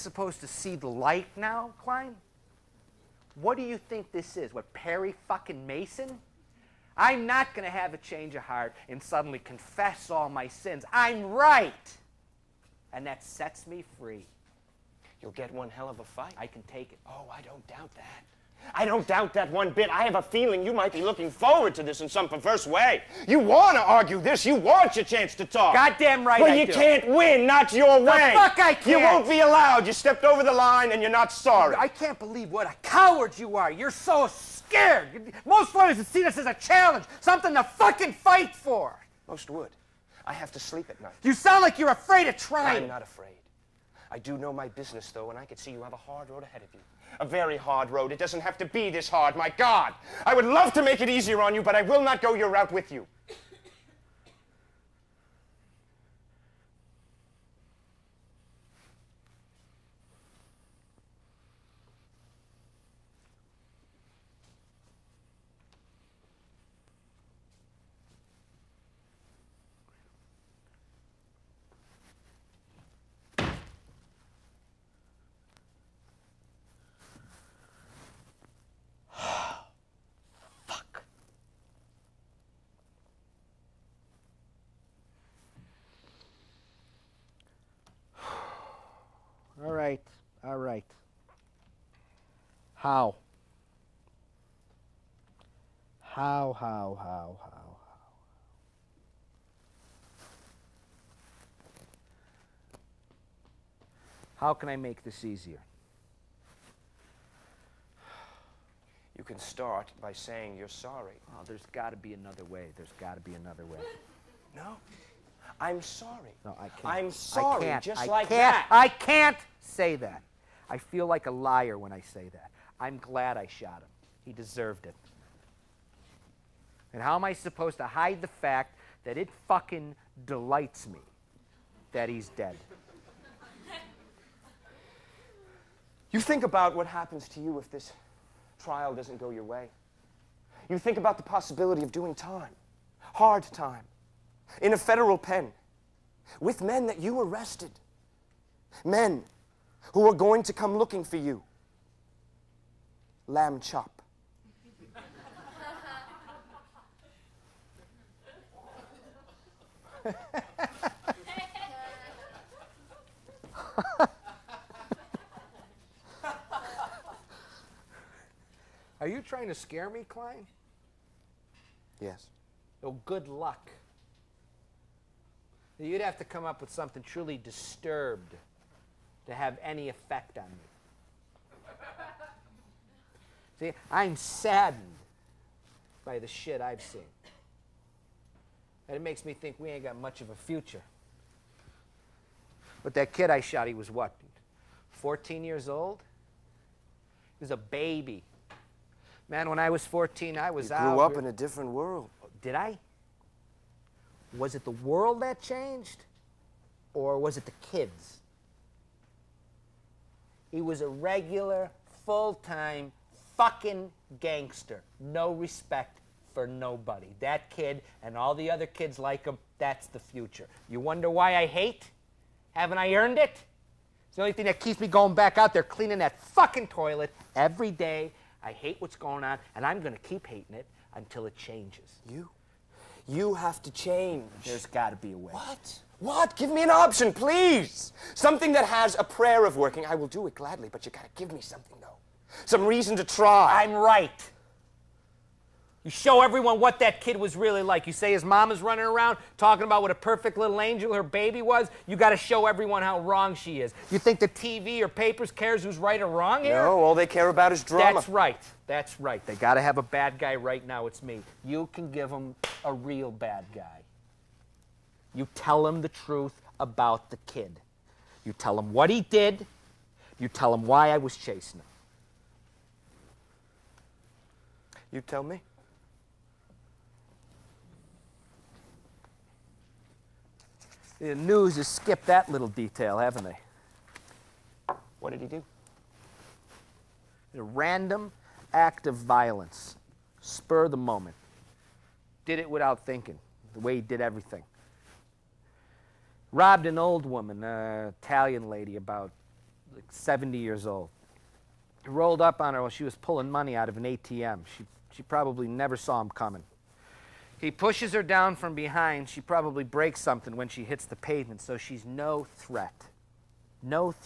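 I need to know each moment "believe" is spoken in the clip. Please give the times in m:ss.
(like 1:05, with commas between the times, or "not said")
0:32.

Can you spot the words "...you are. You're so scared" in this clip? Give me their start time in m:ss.
0:33.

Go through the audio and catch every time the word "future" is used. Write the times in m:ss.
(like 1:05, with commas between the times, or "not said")
3:10, 3:39.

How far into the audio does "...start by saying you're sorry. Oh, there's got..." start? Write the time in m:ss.
1:49.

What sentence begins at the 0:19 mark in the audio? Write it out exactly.
I have a feeling you might be looking forward to this in some perverse way.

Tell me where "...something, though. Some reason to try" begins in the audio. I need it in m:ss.
4:01.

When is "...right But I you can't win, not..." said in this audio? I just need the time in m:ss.
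0:26.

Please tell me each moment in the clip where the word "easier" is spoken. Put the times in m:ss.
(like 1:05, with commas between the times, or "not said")
0:51, 1:45.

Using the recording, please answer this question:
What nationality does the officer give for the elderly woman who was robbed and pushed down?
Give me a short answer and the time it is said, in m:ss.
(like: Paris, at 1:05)
Italian, at 4:58.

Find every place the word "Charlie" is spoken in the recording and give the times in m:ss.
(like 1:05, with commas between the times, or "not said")
not said.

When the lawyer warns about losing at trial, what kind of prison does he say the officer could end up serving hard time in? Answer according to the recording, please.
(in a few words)
federal pen.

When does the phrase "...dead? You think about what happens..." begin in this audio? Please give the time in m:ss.
2:12.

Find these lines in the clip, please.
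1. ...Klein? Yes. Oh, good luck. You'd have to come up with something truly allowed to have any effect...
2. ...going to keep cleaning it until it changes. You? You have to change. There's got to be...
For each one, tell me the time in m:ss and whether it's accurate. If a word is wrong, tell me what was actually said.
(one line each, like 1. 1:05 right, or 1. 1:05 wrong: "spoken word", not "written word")
1. 2:50 wrong: "disturbed", not "allowed"
2. 3:49 wrong: "hating", not "cleaning".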